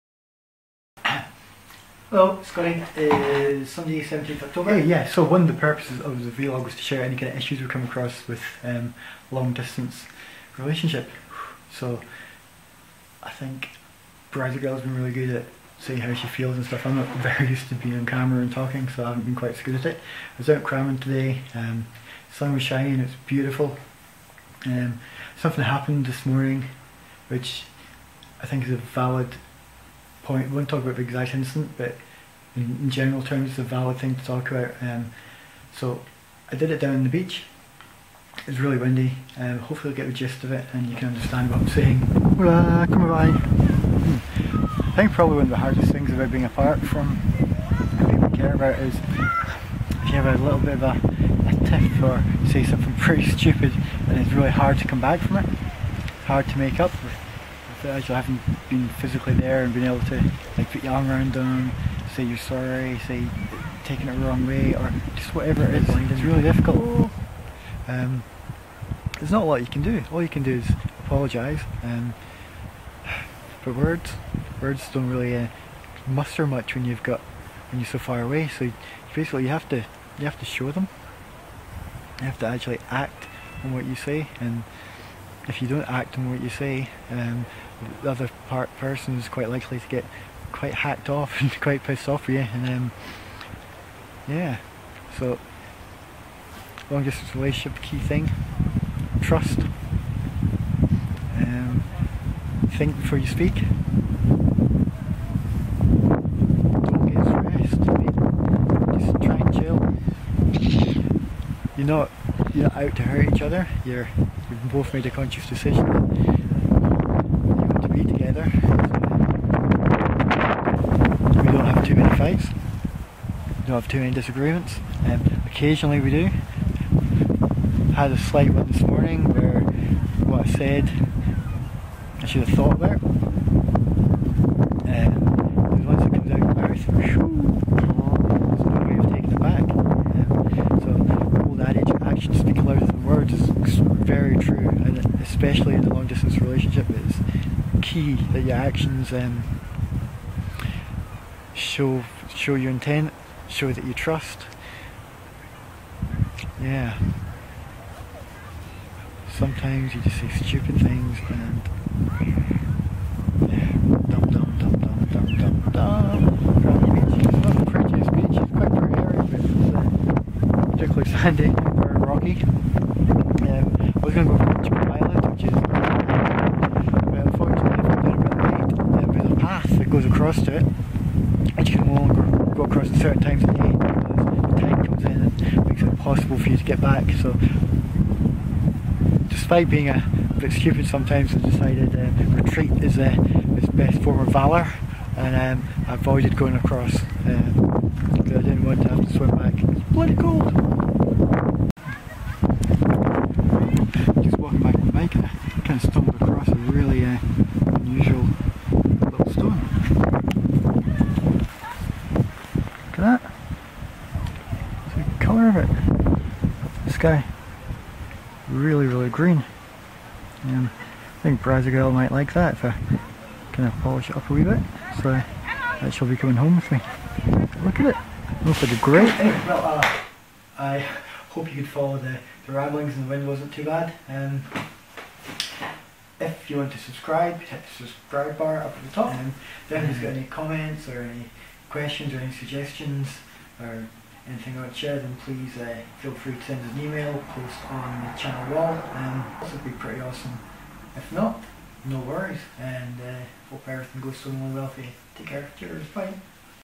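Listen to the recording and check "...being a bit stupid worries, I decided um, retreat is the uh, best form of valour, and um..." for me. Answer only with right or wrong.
wrong.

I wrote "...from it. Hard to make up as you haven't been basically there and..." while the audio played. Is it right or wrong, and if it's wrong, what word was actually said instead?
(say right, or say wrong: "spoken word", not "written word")
wrong: "physically", not "basically".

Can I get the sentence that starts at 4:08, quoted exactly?
and it would be pretty awesome.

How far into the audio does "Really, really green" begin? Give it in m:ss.
3:38.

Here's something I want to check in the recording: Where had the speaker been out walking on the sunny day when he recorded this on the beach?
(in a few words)
Cramond.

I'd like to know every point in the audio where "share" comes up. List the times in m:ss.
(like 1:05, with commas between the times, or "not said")
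0:06, 4:04.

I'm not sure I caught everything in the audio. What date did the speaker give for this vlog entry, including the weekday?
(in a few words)
Sunday, 17th October.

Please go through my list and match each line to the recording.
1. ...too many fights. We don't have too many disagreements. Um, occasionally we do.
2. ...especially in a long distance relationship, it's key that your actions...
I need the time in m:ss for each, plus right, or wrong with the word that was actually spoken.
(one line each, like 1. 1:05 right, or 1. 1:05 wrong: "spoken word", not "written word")
1. 2:01 right
2. 2:25 right.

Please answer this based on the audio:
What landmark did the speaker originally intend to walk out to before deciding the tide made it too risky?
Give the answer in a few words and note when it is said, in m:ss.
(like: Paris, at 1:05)
The Island, at 2:54.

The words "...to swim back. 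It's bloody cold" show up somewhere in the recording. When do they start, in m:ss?
3:19.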